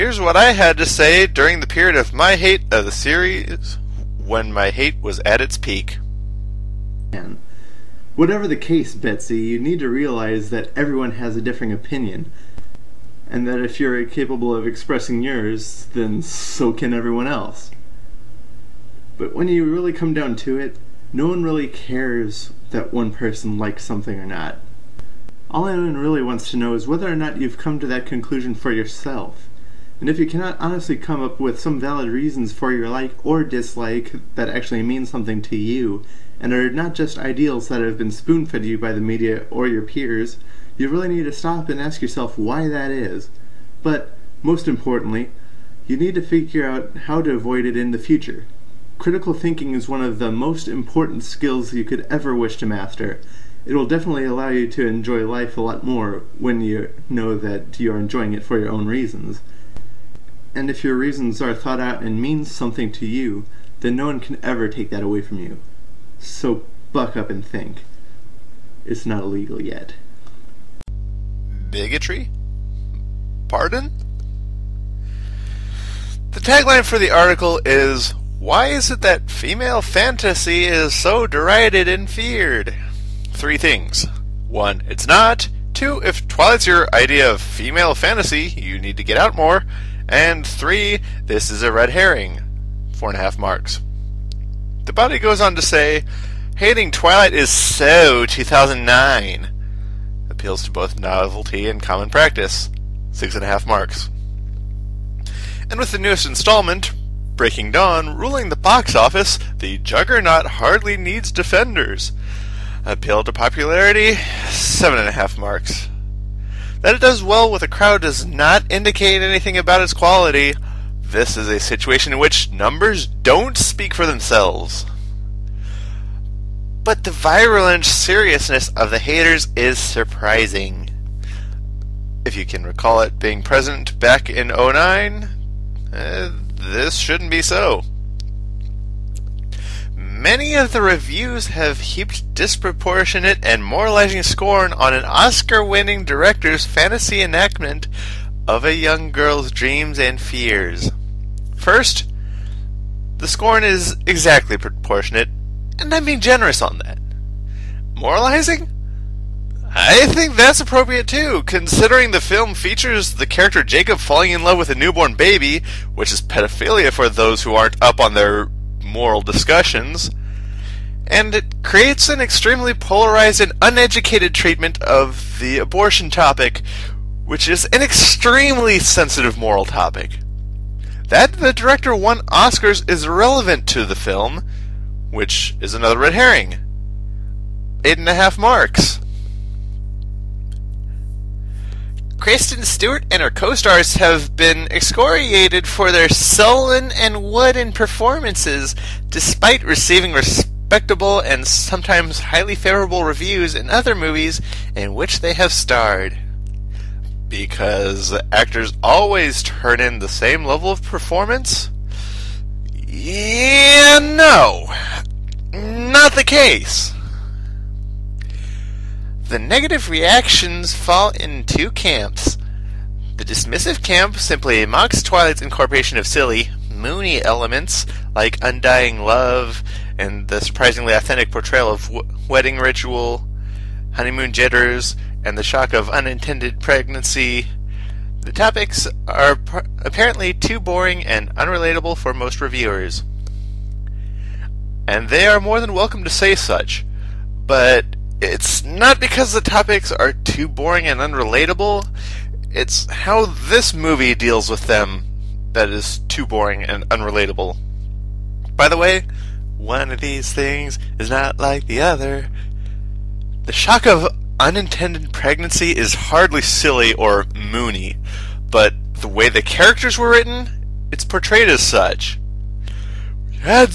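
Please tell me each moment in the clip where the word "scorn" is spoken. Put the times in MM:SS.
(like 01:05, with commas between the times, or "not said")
02:24, 02:33.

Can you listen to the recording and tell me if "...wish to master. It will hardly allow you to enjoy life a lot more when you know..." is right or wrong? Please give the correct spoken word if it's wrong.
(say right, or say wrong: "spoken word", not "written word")
wrong: "definitely", not "hardly".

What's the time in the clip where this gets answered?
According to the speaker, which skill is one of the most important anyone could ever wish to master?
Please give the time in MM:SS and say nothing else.
00:48.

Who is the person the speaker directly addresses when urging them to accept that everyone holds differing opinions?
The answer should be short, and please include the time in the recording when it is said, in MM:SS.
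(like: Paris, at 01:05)
Betsy, at 00:08.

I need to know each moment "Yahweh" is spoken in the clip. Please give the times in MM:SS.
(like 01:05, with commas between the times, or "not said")
not said.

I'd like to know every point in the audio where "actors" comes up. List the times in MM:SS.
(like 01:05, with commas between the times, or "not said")
03:28.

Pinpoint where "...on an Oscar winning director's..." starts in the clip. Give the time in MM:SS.
02:24.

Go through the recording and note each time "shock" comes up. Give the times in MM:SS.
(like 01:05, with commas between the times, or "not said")
03:55, 04:23.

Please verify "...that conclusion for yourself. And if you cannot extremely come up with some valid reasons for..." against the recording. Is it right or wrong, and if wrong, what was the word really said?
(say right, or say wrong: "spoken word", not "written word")
wrong: "honestly", not "extremely".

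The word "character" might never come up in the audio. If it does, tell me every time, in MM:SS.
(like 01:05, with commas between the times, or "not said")
02:43, 04:29.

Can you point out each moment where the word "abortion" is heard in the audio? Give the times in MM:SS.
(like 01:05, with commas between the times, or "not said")
02:55.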